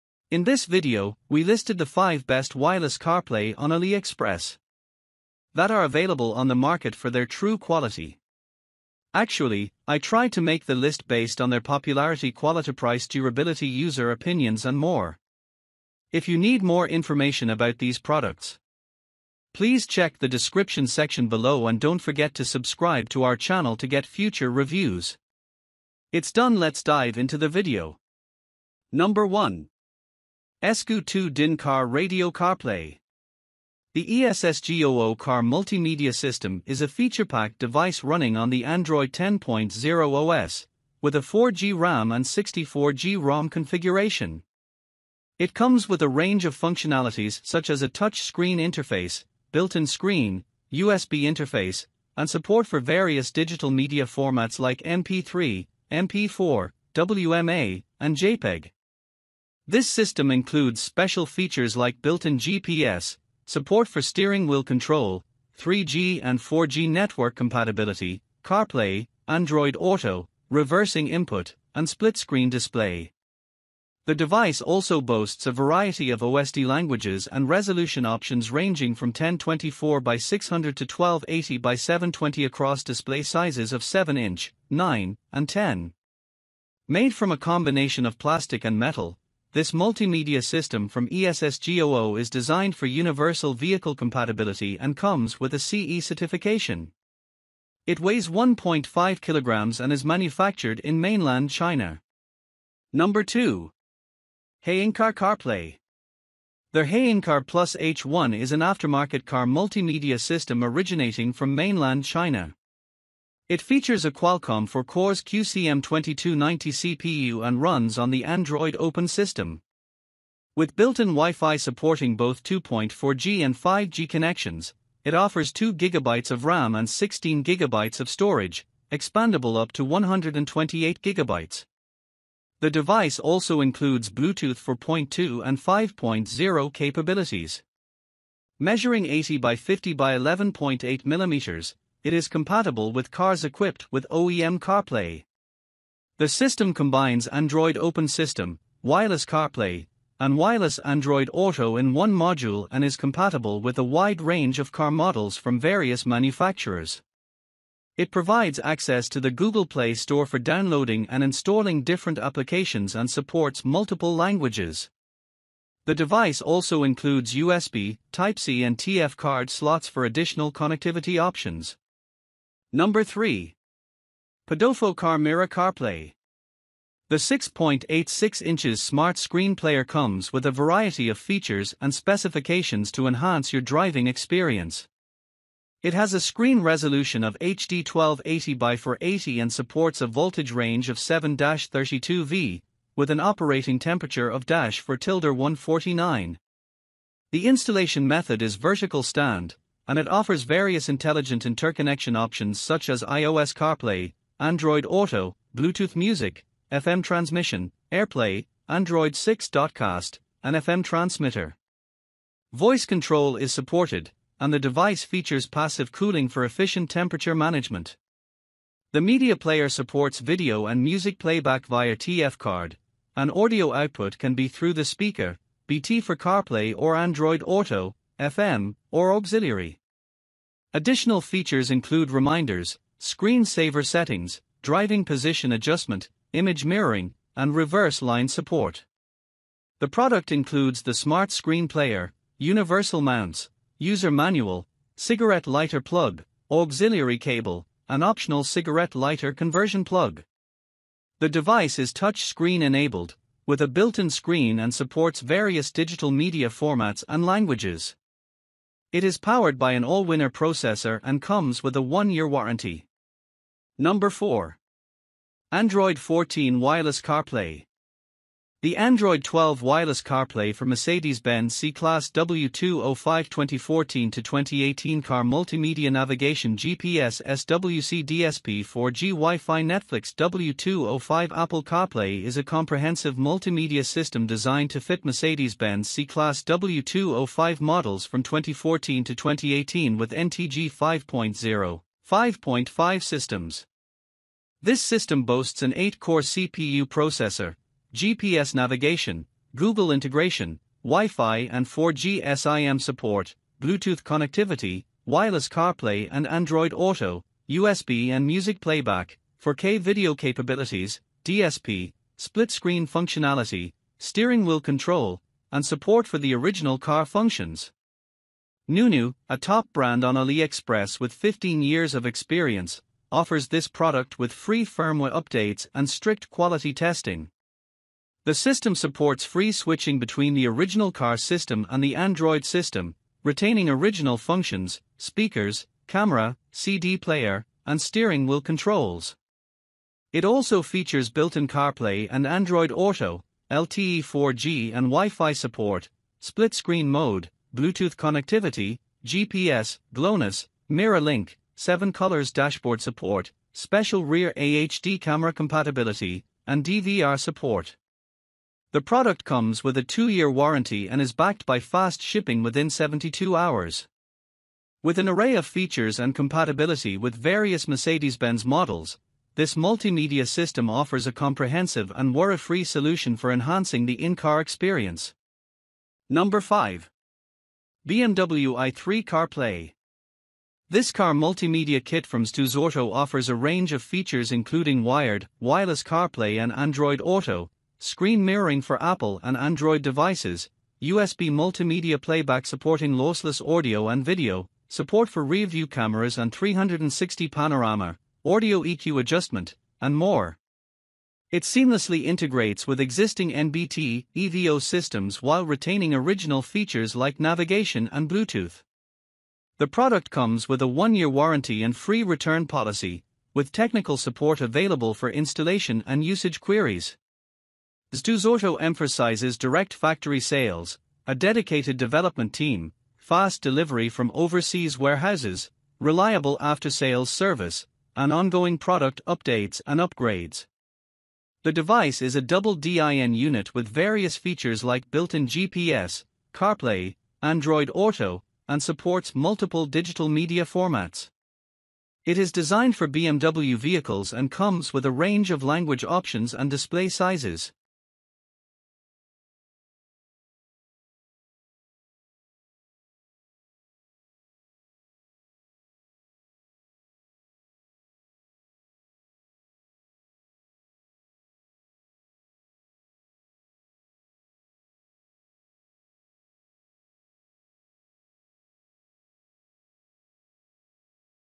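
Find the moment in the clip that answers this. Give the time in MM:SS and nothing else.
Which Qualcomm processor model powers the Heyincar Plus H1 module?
01:55.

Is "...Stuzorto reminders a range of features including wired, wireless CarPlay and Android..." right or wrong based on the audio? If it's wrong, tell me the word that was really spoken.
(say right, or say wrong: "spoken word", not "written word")
wrong: "offers", not "reminders".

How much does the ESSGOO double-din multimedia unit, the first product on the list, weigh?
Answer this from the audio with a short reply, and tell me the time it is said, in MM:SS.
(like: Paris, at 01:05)
1.5 kilograms, at 01:38.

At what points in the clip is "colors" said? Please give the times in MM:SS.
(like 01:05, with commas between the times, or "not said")
05:51.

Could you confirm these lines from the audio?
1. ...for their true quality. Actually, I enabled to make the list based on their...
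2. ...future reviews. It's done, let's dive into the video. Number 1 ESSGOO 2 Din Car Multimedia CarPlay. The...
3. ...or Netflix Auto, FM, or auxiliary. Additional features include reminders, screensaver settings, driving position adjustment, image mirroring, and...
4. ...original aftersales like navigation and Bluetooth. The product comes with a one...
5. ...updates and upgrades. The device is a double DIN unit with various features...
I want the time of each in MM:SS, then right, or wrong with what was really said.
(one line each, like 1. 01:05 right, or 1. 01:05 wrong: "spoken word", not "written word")
1. 00:06 wrong: "tried", not "enabled"
2. 00:24 wrong: "Radio", not "Multimedia"
3. 03:46 wrong: "Android", not "Netflix"
4. 06:45 wrong: "features", not "aftersales"
5. 07:09 right.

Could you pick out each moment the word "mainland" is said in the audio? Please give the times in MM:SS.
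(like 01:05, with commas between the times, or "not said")
01:41, 01:51.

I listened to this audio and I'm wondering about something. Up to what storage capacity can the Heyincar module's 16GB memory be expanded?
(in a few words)
128GB.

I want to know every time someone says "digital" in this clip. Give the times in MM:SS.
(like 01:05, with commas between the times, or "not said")
00:53, 04:15, 07:19.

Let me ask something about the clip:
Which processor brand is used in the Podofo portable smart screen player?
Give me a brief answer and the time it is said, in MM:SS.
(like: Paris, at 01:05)
Allwinner, at 04:19.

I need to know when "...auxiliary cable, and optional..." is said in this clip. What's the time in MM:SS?
04:06.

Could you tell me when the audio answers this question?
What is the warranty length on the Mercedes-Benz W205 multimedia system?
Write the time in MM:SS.
05:59.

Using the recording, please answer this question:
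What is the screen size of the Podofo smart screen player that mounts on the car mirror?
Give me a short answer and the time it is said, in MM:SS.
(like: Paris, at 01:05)
6.86 inches, at 02:57.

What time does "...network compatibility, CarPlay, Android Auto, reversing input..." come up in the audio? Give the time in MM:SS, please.
01:06.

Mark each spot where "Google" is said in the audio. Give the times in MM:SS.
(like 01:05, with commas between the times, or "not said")
02:39, 04:59.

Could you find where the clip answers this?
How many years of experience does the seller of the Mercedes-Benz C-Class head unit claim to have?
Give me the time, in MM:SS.
05:21.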